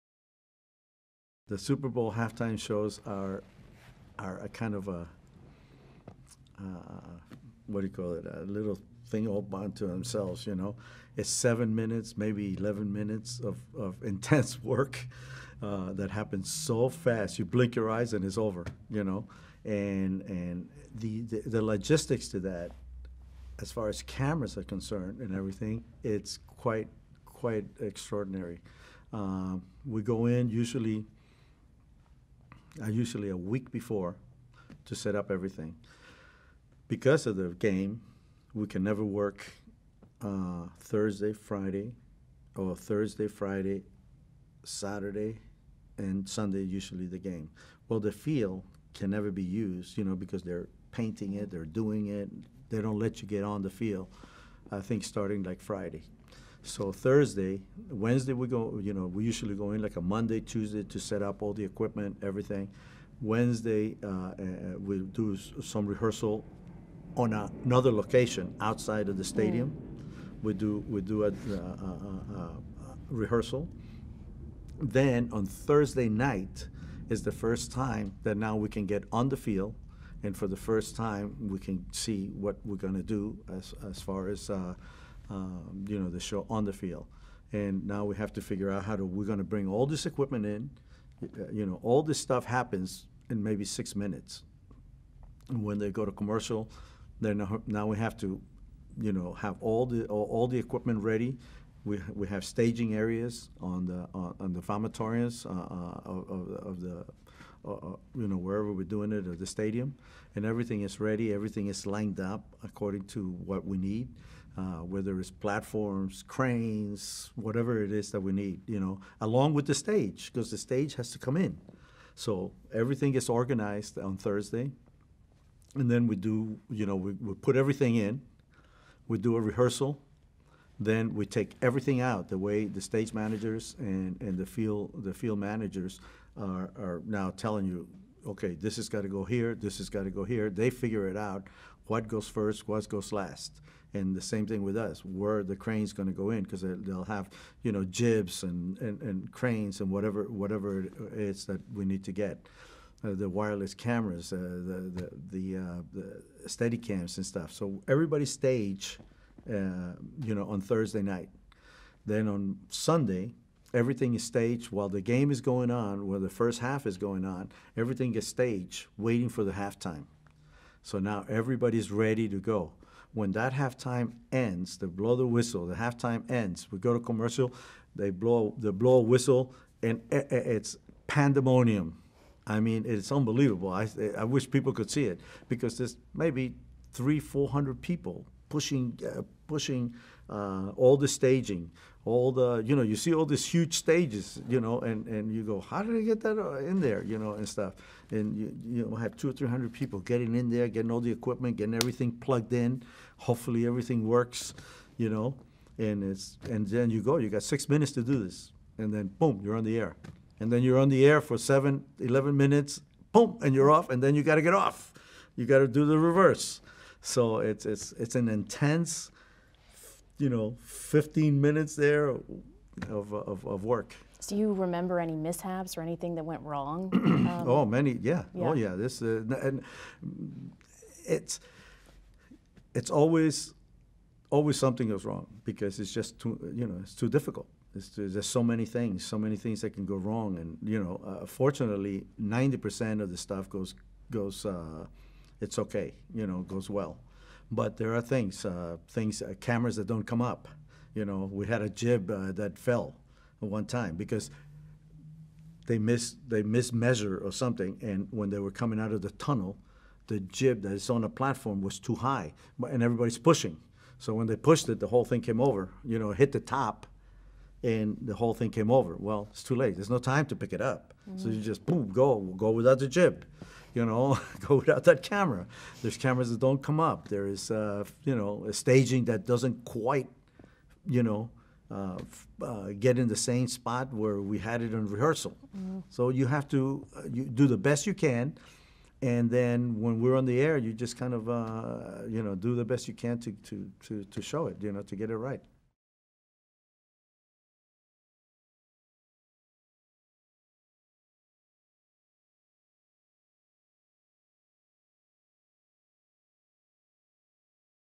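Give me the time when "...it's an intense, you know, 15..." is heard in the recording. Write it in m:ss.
3:37.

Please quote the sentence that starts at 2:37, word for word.
So everybody stage, uh, you know, on Thursday night.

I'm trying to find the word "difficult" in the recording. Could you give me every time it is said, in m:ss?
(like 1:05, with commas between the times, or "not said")
3:57.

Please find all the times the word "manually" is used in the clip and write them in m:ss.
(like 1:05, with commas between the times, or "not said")
not said.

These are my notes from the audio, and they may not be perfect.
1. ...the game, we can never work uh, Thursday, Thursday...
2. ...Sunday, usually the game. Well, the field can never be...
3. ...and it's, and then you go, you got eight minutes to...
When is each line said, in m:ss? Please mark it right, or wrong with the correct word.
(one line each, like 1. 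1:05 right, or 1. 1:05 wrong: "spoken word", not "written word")
1. 0:37 wrong: "Friday", not "Thursday"
2. 0:46 right
3. 3:25 wrong: "six", not "eight".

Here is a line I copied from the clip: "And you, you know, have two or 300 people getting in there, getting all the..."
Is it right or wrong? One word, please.
right.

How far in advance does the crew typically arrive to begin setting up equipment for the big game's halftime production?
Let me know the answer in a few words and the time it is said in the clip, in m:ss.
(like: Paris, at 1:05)
A week before, at 0:33.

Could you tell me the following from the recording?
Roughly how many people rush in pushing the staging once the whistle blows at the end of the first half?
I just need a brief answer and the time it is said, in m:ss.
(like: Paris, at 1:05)
300-400, at 3:06.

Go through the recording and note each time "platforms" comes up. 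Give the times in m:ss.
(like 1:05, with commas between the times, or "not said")
1:55, 4:21.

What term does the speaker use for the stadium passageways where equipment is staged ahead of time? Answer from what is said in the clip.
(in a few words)
Vomitoriums.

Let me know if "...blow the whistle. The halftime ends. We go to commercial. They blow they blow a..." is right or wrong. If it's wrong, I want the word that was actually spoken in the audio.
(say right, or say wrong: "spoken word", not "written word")
right.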